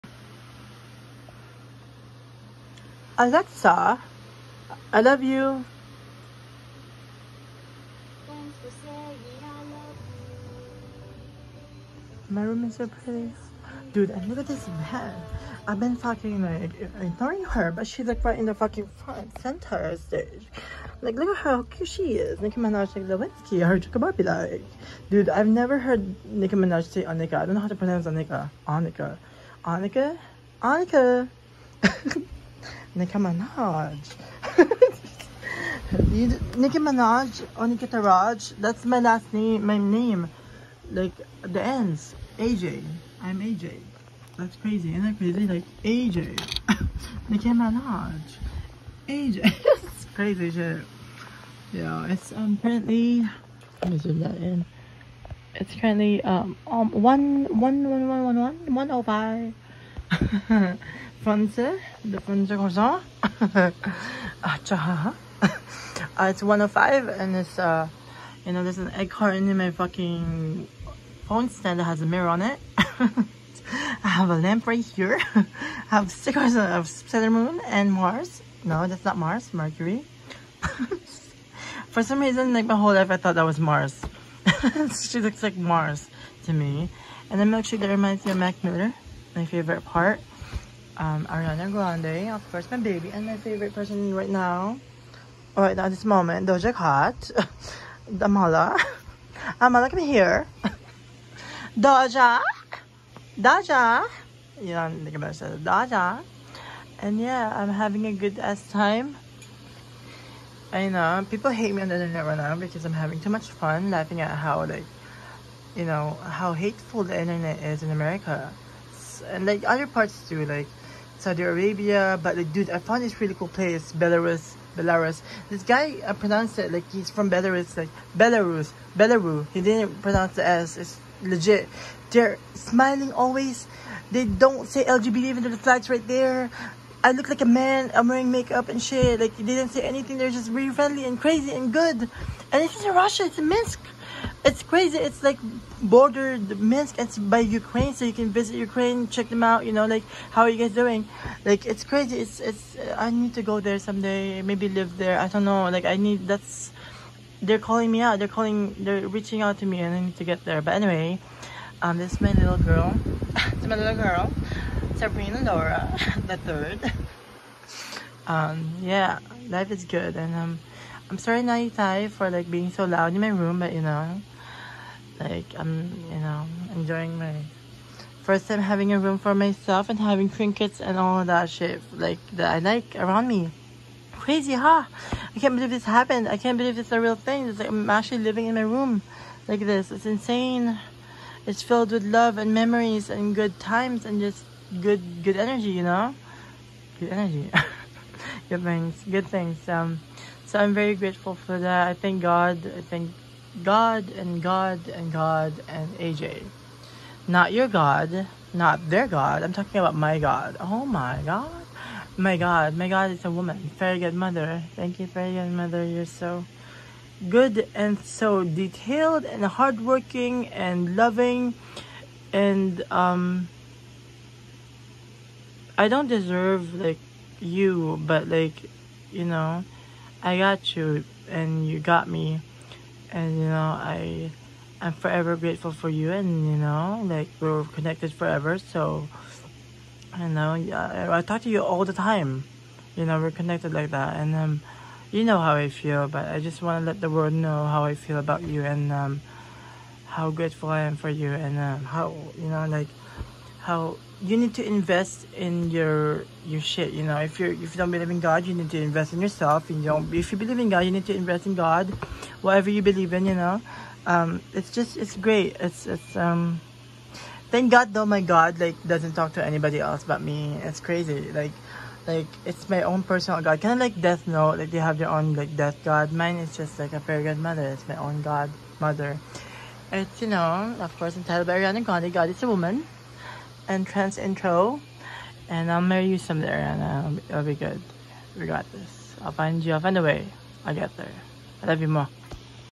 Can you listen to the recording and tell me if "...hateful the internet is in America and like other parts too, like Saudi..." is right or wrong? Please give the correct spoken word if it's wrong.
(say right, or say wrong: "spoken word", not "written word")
right.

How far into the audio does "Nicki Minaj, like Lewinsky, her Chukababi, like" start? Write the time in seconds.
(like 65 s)
22 s.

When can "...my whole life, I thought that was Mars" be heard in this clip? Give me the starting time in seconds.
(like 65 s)
82 s.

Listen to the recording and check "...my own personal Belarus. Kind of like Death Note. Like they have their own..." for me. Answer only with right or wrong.
wrong.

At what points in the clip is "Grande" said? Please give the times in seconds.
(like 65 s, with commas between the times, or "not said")
91 s, 281 s.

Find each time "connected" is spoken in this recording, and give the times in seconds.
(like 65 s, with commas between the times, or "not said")
237 s, 243 s.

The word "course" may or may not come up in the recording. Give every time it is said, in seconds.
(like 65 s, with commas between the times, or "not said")
92 s, 280 s.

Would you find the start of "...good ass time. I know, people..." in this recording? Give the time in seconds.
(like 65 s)
108 s.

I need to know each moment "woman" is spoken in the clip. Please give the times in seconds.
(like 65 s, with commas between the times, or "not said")
213 s, 282 s.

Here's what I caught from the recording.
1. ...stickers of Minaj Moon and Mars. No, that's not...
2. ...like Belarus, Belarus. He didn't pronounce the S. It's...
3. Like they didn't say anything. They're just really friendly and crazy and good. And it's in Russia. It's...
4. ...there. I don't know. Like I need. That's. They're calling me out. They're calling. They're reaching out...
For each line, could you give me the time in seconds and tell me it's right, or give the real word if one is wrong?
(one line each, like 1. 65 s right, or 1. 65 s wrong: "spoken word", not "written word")
1. 76 s wrong: "Saturn", not "Minaj"
2. 127 s right
3. 139 s right
4. 154 s right.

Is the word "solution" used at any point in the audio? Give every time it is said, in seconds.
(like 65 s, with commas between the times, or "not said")
not said.